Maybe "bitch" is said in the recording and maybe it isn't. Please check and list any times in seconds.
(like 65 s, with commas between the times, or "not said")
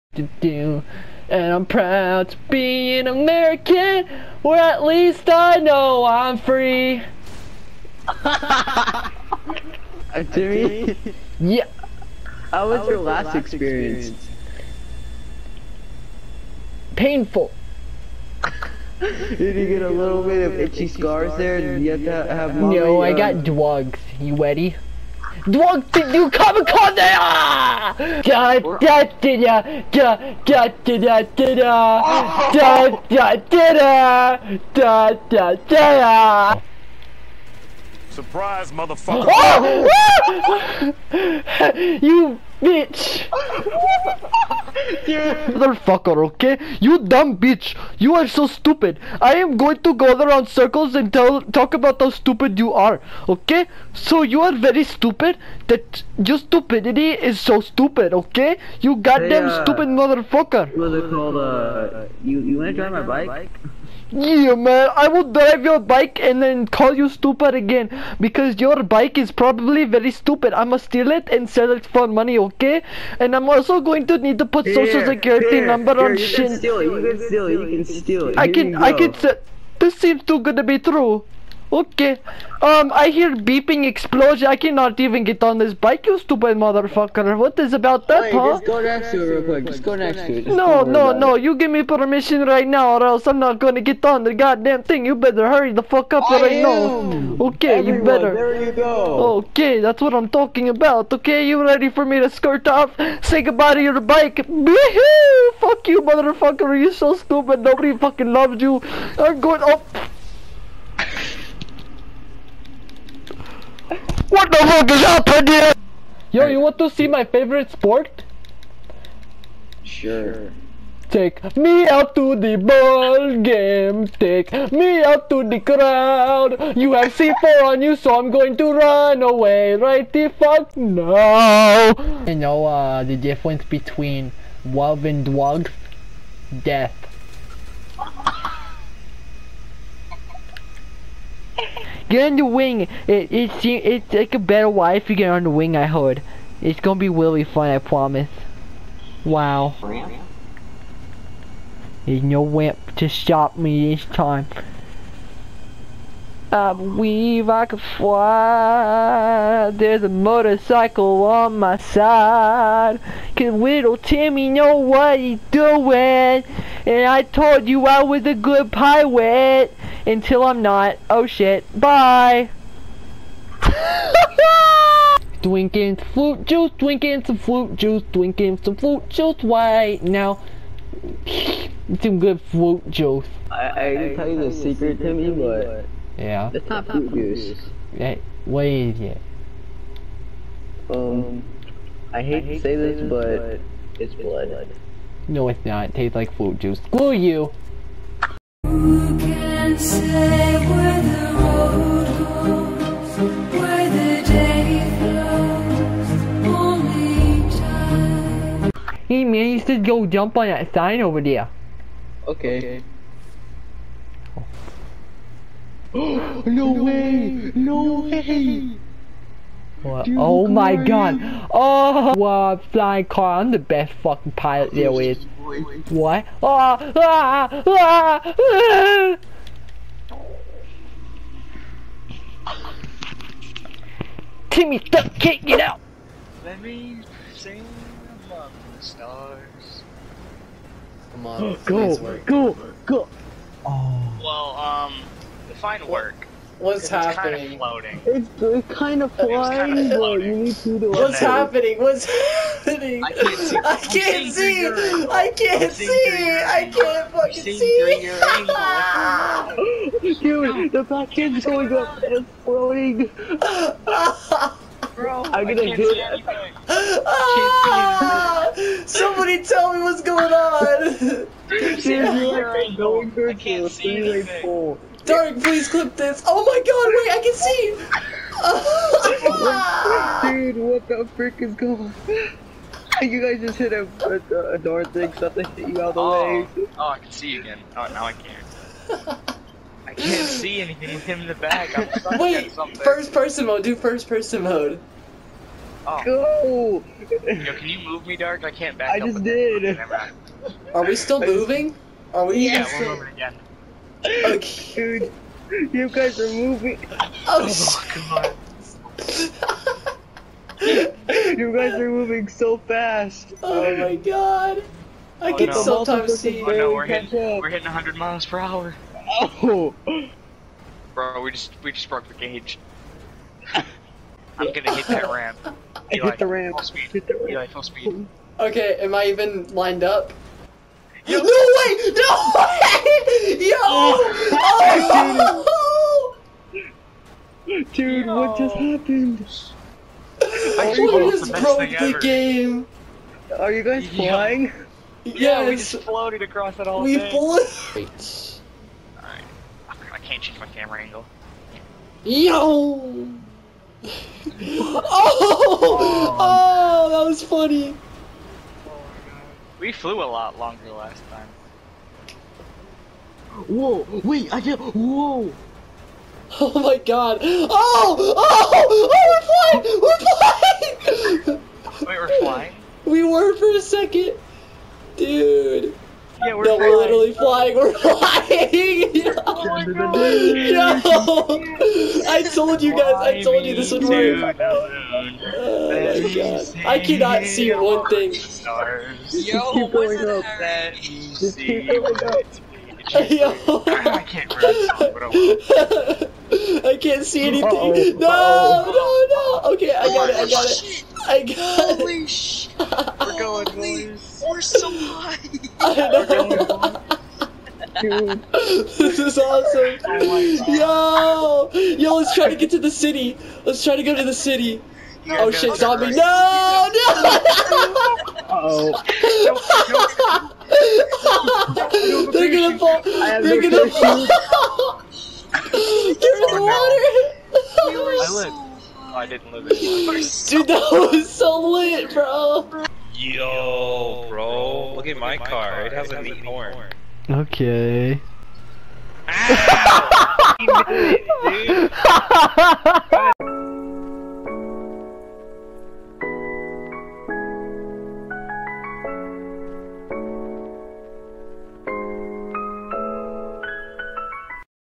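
42 s, 47 s.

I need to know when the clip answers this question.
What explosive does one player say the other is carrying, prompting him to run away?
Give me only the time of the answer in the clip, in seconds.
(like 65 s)
127 s.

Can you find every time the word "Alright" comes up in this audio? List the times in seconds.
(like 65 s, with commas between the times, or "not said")
348 s.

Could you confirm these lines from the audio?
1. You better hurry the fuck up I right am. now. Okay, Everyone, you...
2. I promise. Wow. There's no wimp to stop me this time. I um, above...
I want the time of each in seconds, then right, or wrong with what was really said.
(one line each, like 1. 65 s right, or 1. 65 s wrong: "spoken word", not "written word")
1. 95 s right
2. 147 s wrong: "believe", not "above".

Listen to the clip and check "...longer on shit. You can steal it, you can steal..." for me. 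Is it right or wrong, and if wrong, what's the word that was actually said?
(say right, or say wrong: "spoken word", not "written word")
wrong: "number", not "longer".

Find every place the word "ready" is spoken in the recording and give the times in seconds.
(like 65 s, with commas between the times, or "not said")
24 s, 101 s.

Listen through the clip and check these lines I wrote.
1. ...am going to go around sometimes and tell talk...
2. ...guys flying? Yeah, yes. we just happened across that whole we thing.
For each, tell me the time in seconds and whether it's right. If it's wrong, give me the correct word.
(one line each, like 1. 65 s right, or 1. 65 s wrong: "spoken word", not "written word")
1. 49 s wrong: "circles", not "sometimes"
2. 343 s wrong: "floated", not "happened".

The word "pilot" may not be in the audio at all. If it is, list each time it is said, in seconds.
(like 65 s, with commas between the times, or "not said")
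168 s, 224 s.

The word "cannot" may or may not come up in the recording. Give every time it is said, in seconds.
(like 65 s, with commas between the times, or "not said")
84 s, 386 s.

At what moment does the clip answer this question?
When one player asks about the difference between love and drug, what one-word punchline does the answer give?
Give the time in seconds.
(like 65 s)
136 s.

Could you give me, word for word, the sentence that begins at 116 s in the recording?
Yo, you want to see my favorite sport?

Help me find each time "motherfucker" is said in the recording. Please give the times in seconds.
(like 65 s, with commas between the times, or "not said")
38 s, 45 s, 59 s, 86 s, 106 s.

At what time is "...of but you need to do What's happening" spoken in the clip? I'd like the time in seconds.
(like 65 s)
249 s.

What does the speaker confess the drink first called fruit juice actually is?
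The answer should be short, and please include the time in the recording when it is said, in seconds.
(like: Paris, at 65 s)
Blood, at 193 s.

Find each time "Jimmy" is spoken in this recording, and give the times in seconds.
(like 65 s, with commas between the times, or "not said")
10 s.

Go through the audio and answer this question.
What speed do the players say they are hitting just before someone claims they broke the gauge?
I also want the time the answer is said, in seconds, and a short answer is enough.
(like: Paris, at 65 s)
100 miles per hour, at 317 s.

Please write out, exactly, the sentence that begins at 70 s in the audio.
I'm gonna steal it and sell it for money, okay?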